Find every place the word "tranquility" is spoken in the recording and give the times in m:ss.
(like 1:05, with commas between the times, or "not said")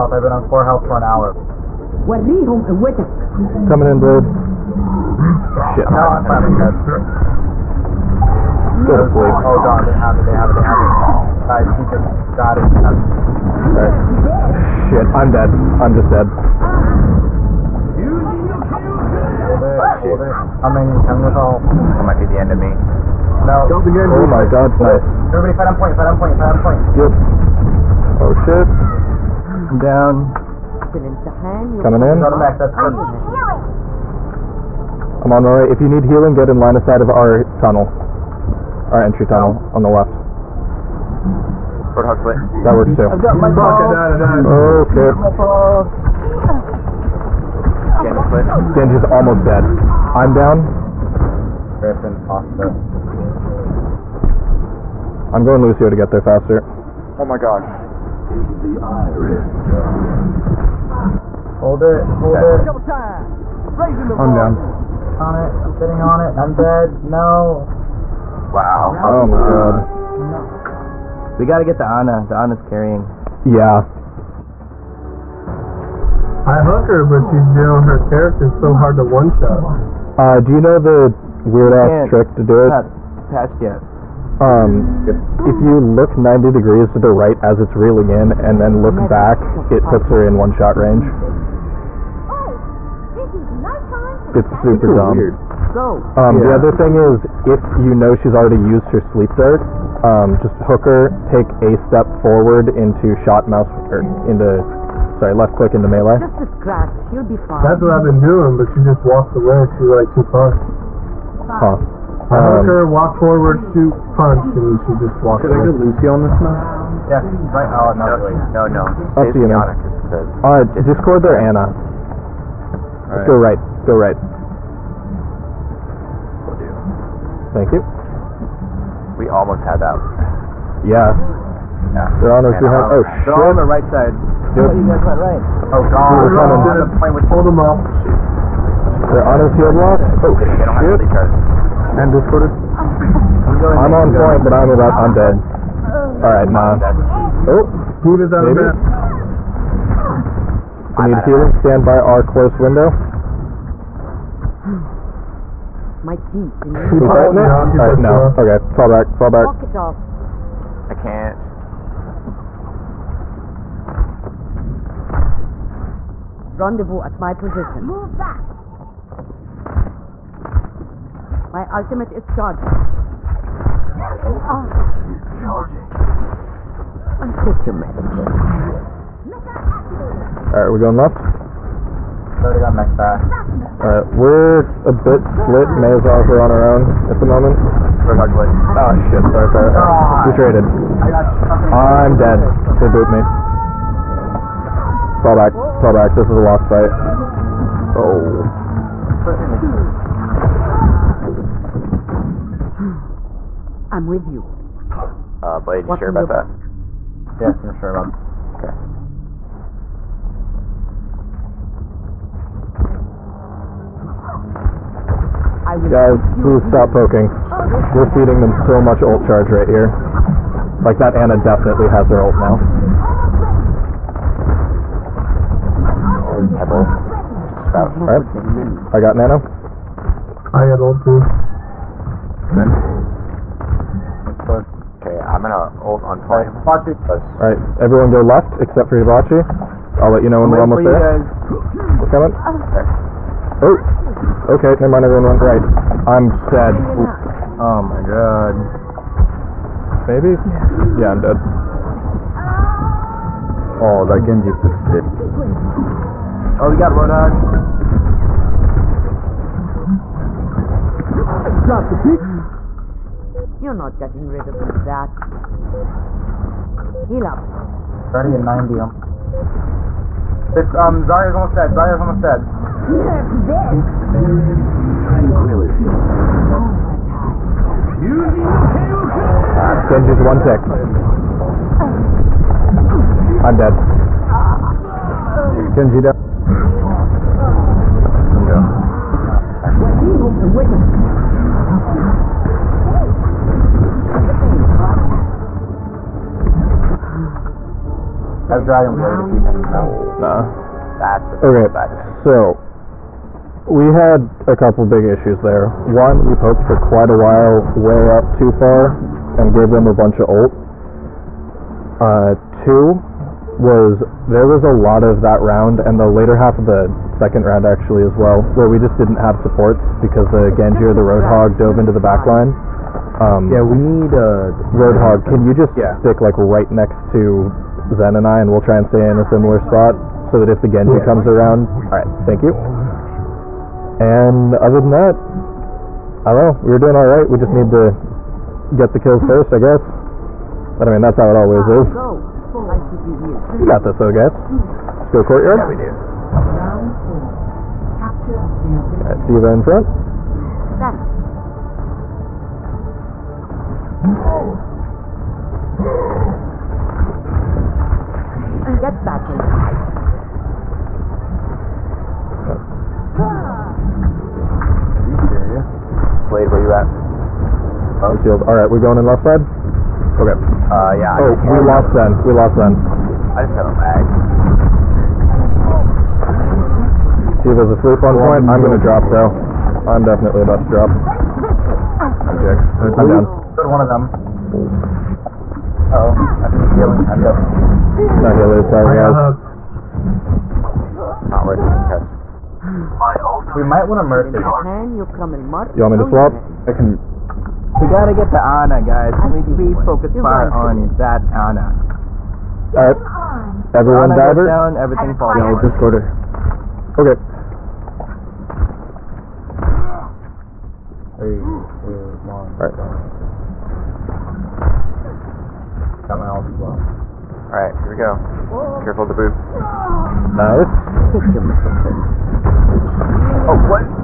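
4:35.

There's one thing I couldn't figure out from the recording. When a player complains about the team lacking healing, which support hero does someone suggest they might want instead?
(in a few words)
Mercy.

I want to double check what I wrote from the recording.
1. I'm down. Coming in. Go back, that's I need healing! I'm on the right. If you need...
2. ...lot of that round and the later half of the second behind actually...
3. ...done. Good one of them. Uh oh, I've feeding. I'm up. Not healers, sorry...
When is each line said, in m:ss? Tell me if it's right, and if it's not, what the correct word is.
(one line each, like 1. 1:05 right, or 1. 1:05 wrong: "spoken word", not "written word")
1. 0:29 right
2. 5:14 wrong: "round", not "behind"
3. 6:23 wrong: "healing", not "feeding".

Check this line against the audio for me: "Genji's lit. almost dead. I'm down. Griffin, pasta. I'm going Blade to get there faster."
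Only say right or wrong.
wrong.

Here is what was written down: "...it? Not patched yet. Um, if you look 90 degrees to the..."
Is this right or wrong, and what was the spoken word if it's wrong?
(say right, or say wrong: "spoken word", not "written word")
right.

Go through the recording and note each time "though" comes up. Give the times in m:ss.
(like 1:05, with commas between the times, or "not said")
5:43, 6:19.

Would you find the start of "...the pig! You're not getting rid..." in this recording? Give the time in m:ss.
4:21.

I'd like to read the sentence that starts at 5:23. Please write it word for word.
Um, yeah, we need uh, Roadhog.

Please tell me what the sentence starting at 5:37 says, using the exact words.
We just need to get the kills first, I guess.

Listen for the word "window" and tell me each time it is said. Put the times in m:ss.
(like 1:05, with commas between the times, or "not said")
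2:32.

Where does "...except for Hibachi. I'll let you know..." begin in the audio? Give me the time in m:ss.
3:58.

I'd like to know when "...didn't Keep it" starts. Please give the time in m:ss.
2:36.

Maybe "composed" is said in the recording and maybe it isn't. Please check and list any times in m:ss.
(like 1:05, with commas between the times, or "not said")
not said.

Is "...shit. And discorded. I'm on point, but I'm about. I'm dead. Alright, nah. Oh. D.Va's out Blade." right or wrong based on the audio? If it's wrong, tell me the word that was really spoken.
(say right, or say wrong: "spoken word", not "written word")
wrong: "Maybe", not "Blade".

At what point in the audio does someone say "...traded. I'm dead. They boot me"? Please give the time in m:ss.
3:10.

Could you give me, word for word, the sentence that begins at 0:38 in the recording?
Our entry tunnel on the left.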